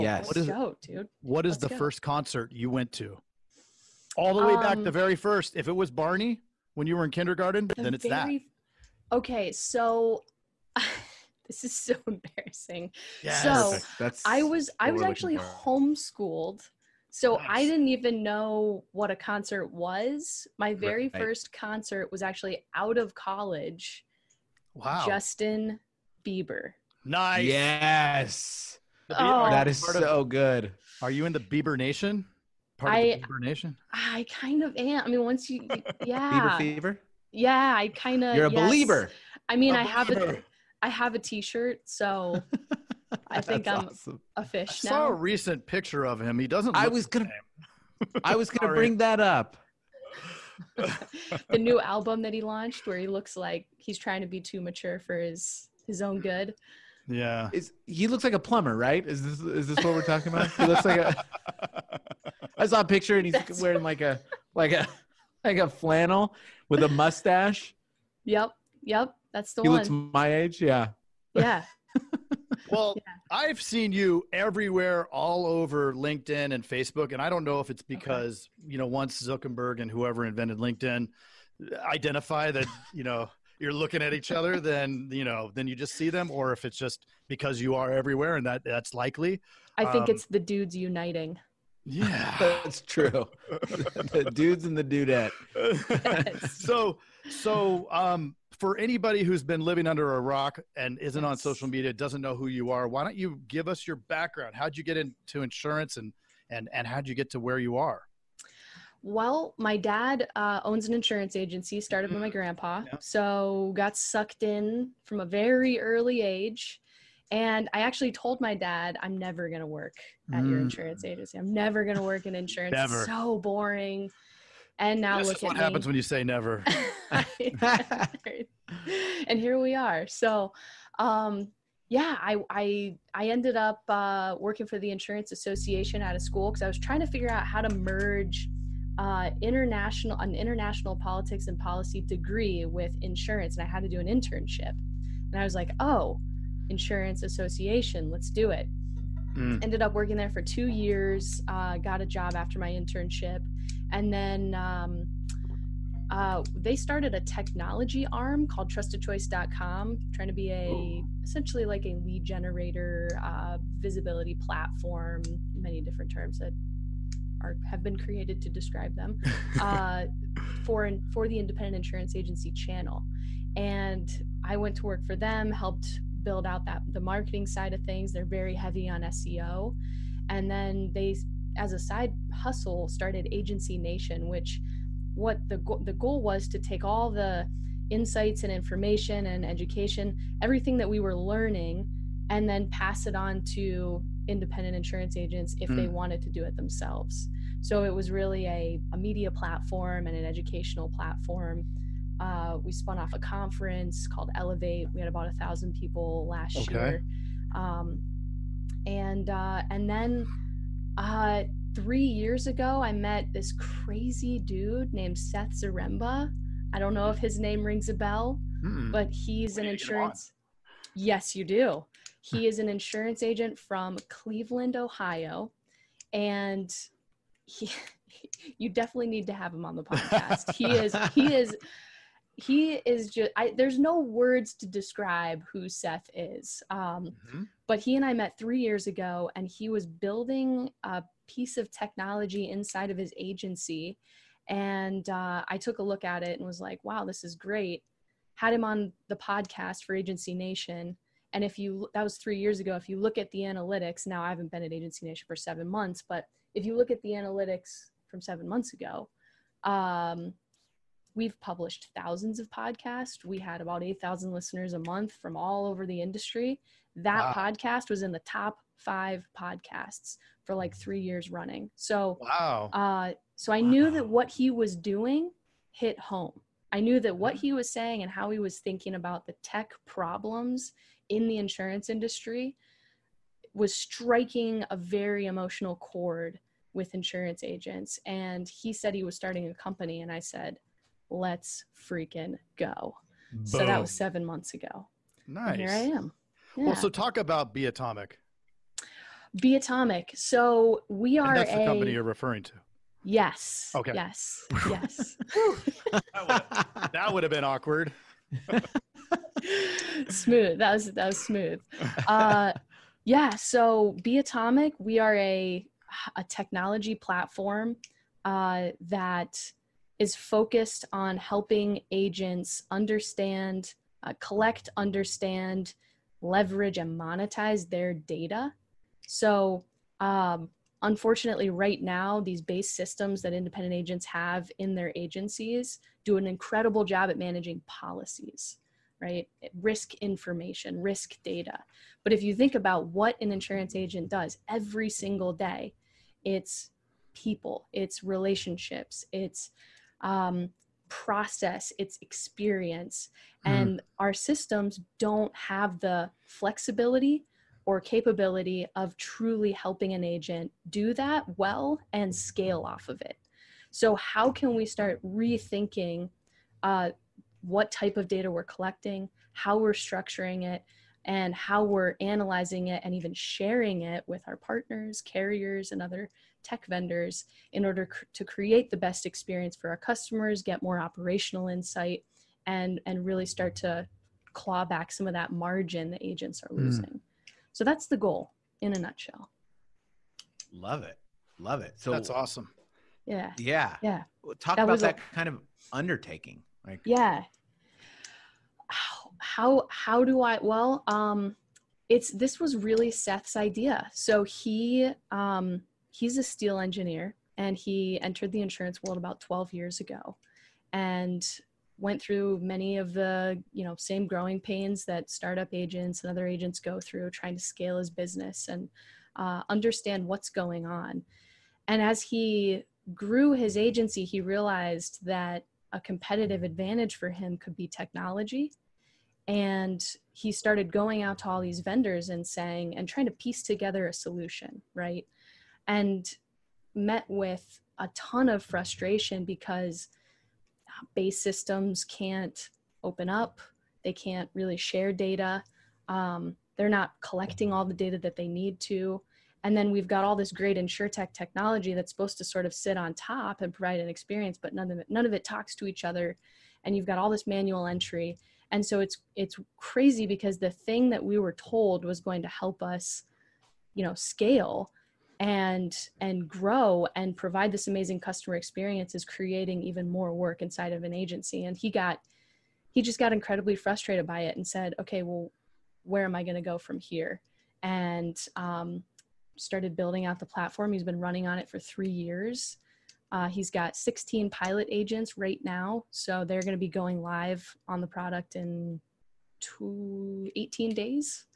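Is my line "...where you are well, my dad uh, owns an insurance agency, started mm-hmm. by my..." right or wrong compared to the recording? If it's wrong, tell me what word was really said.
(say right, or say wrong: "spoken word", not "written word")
right.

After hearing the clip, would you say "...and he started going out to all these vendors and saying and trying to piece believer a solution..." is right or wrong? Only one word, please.
wrong.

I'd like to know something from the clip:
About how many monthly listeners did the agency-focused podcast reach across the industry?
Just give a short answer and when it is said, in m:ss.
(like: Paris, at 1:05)
8000, at 4:23.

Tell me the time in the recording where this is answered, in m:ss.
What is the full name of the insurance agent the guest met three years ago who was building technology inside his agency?
3:35.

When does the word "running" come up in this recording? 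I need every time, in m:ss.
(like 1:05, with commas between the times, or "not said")
4:31, 8:00.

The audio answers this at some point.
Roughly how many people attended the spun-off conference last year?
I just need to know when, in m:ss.
3:25.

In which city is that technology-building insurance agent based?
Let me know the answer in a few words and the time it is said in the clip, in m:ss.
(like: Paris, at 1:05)
Cleveland, Ohio, at 3:44.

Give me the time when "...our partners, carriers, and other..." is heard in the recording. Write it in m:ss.
6:14.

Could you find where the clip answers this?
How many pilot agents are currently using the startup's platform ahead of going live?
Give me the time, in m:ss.
8:03.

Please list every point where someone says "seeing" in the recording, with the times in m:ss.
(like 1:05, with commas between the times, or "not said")
not said.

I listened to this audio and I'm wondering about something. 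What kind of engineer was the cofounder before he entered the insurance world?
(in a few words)
steel engineer.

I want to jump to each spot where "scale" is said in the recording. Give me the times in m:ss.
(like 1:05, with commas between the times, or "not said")
6:02, 6:57, 7:43.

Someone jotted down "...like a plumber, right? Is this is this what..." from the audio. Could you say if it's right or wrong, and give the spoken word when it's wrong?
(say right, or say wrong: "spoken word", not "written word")
right.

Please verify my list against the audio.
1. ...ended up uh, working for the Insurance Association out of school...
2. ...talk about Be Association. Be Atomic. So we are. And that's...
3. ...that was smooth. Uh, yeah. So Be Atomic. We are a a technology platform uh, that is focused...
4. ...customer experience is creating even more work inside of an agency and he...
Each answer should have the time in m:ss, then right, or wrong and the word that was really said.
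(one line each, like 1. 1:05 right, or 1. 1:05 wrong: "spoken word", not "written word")
1. 2:13 right
2. 4:56 wrong: "Atomic", not "Association"
3. 5:10 right
4. 7:48 right.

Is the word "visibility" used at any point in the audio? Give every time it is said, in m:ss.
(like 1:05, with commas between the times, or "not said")
2:43.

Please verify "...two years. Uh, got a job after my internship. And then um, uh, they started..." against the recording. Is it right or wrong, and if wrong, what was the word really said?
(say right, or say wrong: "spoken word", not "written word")
right.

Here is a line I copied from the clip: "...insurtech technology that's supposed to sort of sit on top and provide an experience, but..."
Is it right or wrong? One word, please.
right.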